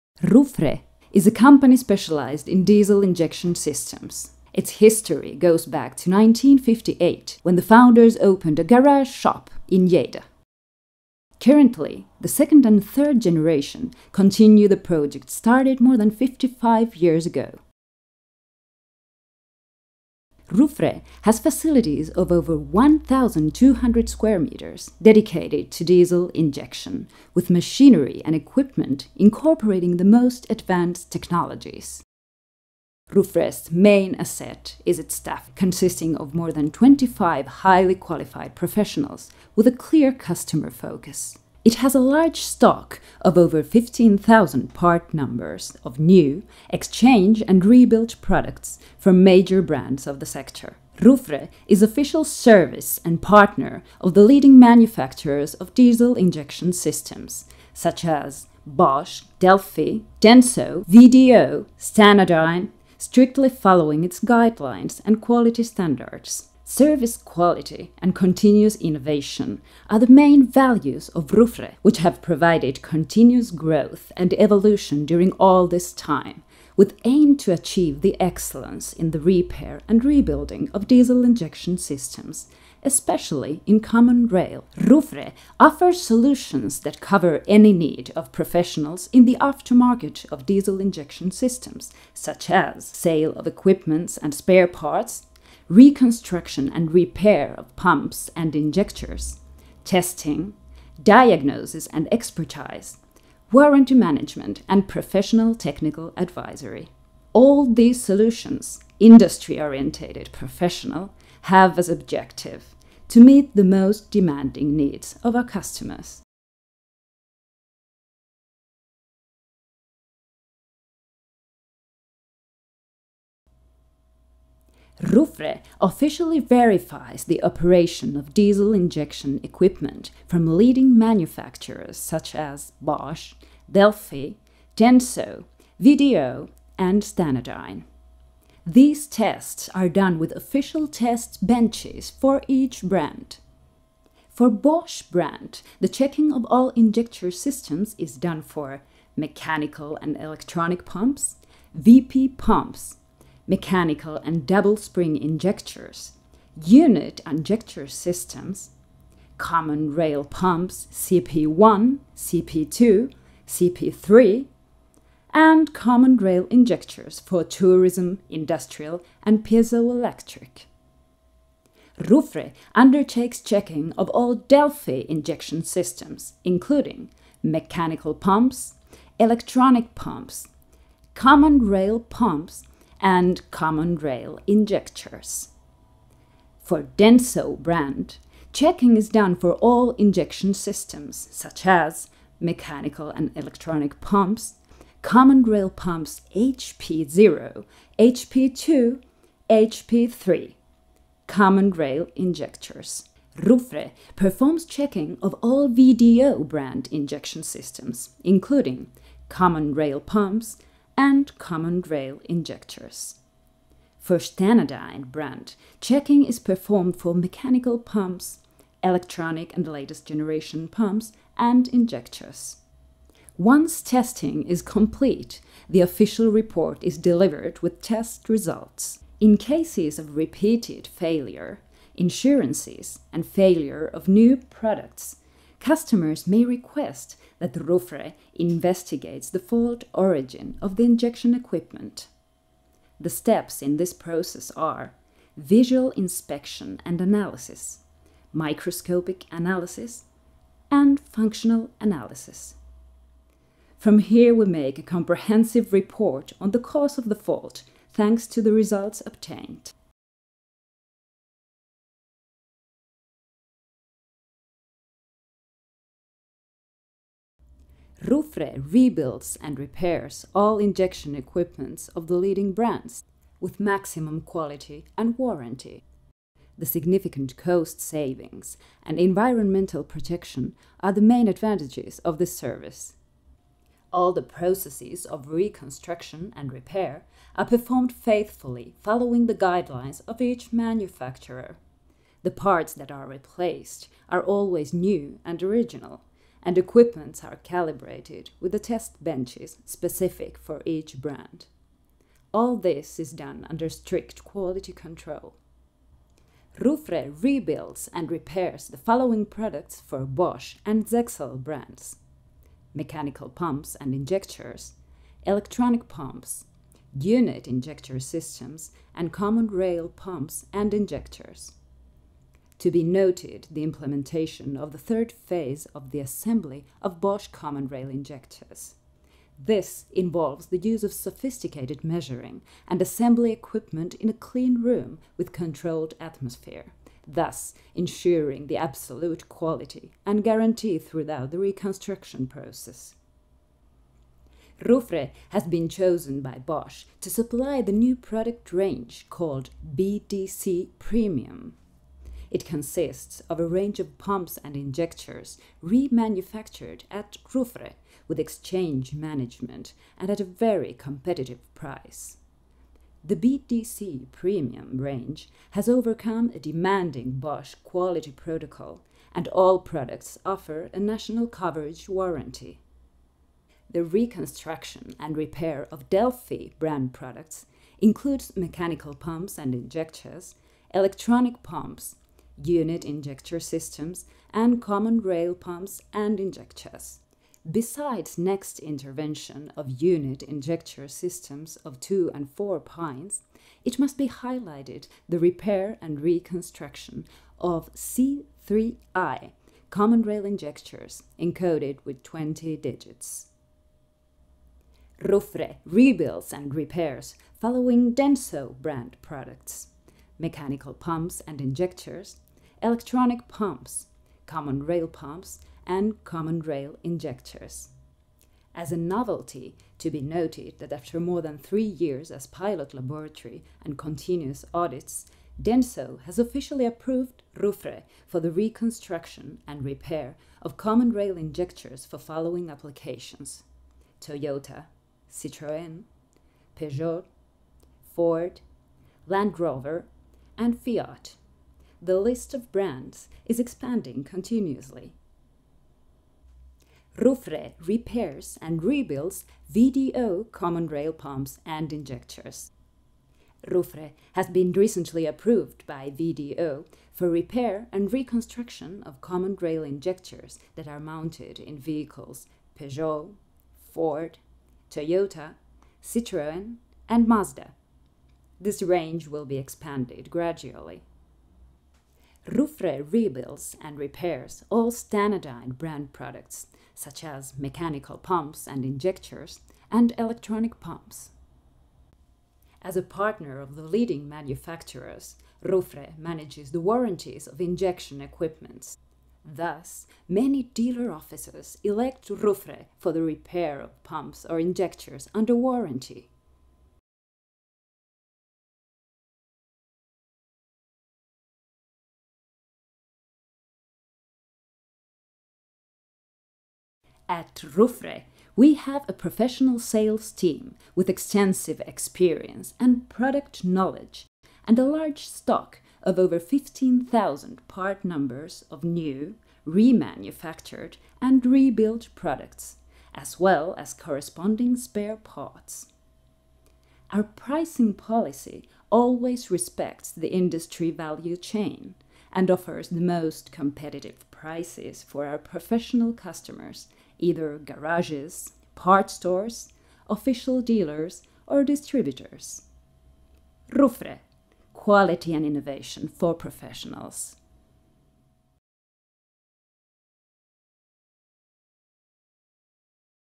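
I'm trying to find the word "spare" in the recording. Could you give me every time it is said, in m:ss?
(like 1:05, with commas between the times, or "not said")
1:34, 8:44.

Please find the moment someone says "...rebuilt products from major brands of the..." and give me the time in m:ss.
0:47.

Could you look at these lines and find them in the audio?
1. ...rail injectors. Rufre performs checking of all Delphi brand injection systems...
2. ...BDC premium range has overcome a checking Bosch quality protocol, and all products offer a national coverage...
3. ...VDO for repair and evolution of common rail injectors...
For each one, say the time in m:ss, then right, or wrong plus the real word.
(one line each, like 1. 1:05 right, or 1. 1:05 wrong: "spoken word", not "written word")
1. 3:21 wrong: "VDO", not "Delphi"
2. 6:03 wrong: "demanding", not "checking"
3. 7:35 wrong: "reconstruction", not "evolution".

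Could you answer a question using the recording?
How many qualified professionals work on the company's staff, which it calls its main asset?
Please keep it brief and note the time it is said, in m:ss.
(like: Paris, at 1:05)
more than 25, at 0:36.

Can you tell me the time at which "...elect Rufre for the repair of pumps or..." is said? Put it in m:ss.
8:11.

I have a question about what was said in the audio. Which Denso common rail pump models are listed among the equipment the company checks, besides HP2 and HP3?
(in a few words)
HP0.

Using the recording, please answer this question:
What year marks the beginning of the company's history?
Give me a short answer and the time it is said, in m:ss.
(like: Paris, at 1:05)
1958, at 0:06.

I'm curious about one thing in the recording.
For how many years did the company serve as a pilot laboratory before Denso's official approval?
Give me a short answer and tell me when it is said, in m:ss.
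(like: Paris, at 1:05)
more than three, at 7:00.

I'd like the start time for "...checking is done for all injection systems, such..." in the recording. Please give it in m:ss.
3:08.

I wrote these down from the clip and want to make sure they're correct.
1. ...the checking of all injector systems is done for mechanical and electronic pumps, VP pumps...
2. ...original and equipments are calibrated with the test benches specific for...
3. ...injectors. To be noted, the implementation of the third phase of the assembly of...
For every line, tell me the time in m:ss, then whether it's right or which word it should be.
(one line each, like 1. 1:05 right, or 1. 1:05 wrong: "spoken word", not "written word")
1. 2:25 right
2. 4:55 right
3. 5:20 right.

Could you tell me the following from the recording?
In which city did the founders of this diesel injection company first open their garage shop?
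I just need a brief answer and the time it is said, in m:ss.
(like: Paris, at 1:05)
Lleida, at 0:09.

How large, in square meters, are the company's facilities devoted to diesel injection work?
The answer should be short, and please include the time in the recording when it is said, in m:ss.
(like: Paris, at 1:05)
over 1,200, at 0:22.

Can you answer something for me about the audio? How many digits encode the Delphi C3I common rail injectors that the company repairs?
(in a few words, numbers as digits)
20.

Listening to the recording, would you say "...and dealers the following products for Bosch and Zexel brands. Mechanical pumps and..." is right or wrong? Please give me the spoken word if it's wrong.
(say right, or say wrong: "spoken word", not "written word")
wrong: "repairs", not "dealers".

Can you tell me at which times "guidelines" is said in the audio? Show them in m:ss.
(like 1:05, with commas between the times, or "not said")
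1:04, 4:49.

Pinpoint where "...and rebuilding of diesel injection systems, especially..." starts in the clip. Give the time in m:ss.
1:19.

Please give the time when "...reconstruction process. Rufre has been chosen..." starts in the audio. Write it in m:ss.
5:41.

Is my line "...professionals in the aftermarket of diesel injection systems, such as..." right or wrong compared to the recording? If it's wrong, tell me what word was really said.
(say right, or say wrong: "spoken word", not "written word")
right.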